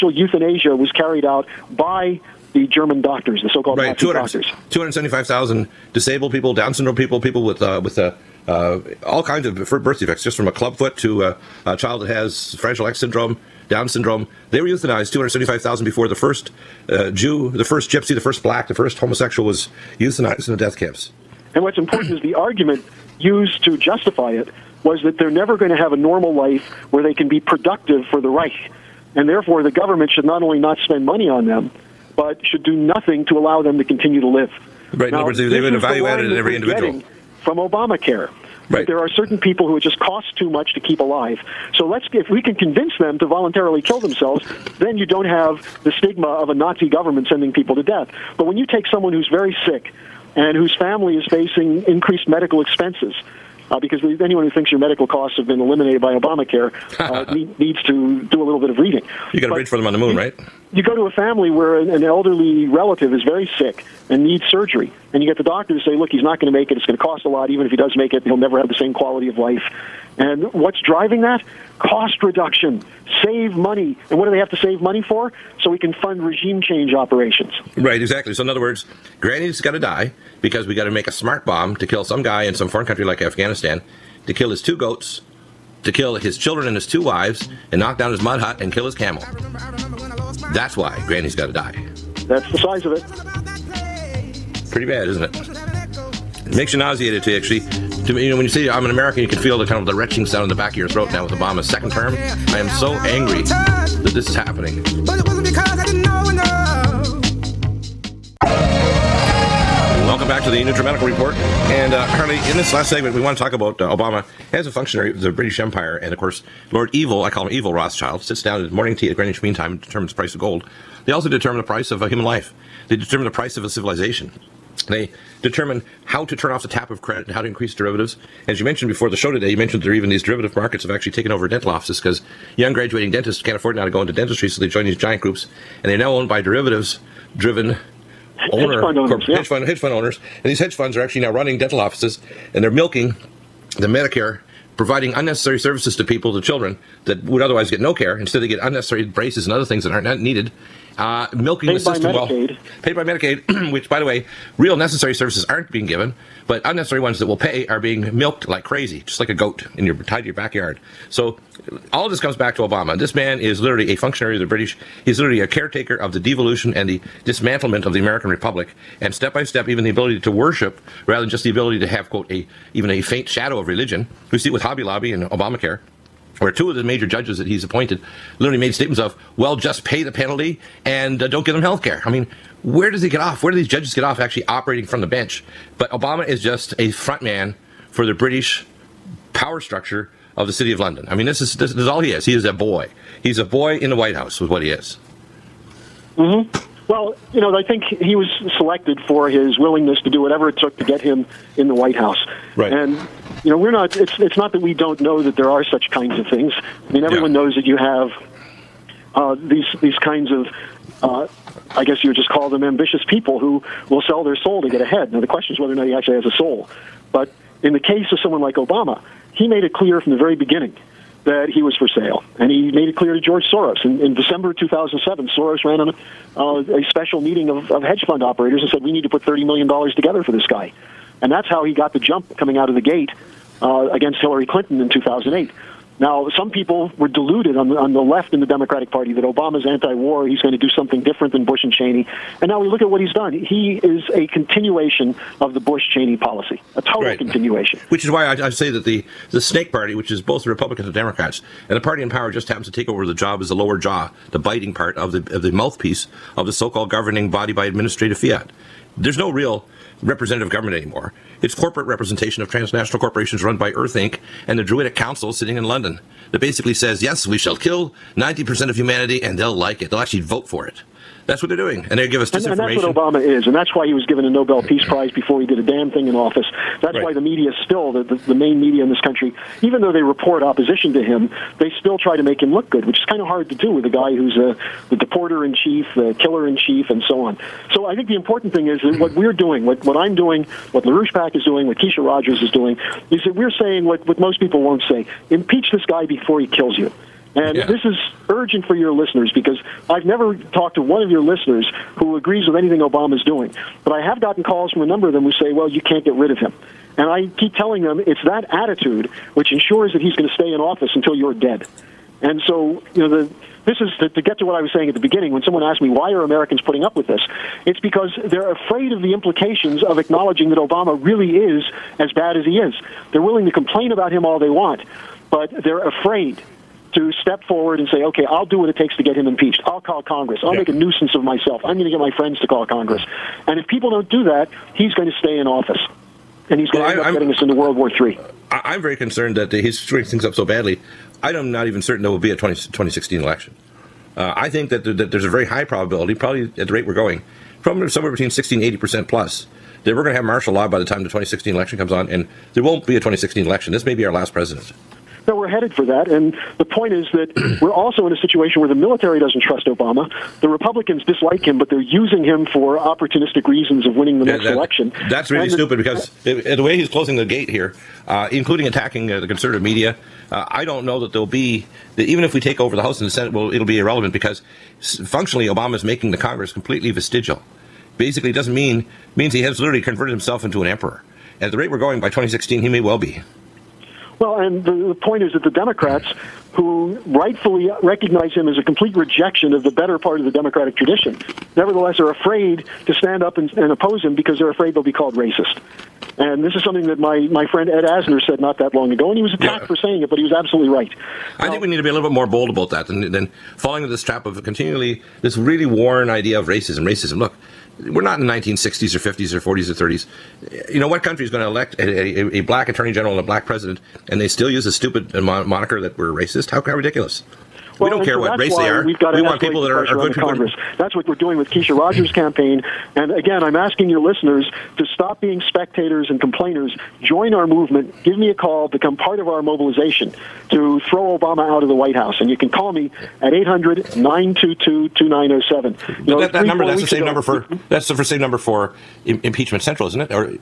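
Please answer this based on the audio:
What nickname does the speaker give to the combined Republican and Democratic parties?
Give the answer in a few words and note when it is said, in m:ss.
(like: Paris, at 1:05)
Snake Party, at 4:09.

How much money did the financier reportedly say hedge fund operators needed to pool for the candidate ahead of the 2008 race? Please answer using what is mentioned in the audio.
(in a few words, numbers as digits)
$30 million.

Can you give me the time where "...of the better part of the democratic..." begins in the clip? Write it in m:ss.
6:29.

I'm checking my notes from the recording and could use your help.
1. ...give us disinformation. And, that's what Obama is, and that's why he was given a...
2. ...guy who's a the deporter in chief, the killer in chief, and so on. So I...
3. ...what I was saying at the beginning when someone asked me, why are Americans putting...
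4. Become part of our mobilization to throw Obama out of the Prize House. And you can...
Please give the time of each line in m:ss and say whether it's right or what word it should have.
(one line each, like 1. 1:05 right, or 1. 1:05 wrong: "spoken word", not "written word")
1. 4:32 right
2. 4:43 right
3. 5:14 right
4. 7:08 wrong: "White", not "Prize".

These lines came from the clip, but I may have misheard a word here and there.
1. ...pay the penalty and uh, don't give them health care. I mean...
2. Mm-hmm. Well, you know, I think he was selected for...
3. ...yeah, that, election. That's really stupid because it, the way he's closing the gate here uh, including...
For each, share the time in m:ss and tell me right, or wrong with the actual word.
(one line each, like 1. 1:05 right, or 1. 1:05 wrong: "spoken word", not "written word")
1. 2:59 right
2. 3:16 right
3. 6:04 right.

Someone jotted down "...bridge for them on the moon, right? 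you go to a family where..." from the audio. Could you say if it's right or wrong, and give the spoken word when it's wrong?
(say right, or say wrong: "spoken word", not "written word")
right.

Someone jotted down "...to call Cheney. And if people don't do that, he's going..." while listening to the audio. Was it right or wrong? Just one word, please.
wrong.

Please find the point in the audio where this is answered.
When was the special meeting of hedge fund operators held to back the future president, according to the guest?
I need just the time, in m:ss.
3:44.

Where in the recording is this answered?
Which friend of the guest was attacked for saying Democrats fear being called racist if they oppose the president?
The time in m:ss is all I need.
6:37.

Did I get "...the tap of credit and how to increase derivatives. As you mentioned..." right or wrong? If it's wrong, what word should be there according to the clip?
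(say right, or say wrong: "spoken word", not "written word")
right.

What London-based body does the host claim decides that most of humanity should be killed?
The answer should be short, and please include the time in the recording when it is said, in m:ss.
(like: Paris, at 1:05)
Druidic Council, at 4:24.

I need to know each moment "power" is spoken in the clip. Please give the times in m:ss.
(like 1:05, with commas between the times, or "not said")
3:09, 4:12.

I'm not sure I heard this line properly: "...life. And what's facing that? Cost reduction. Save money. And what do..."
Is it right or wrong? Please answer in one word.
wrong.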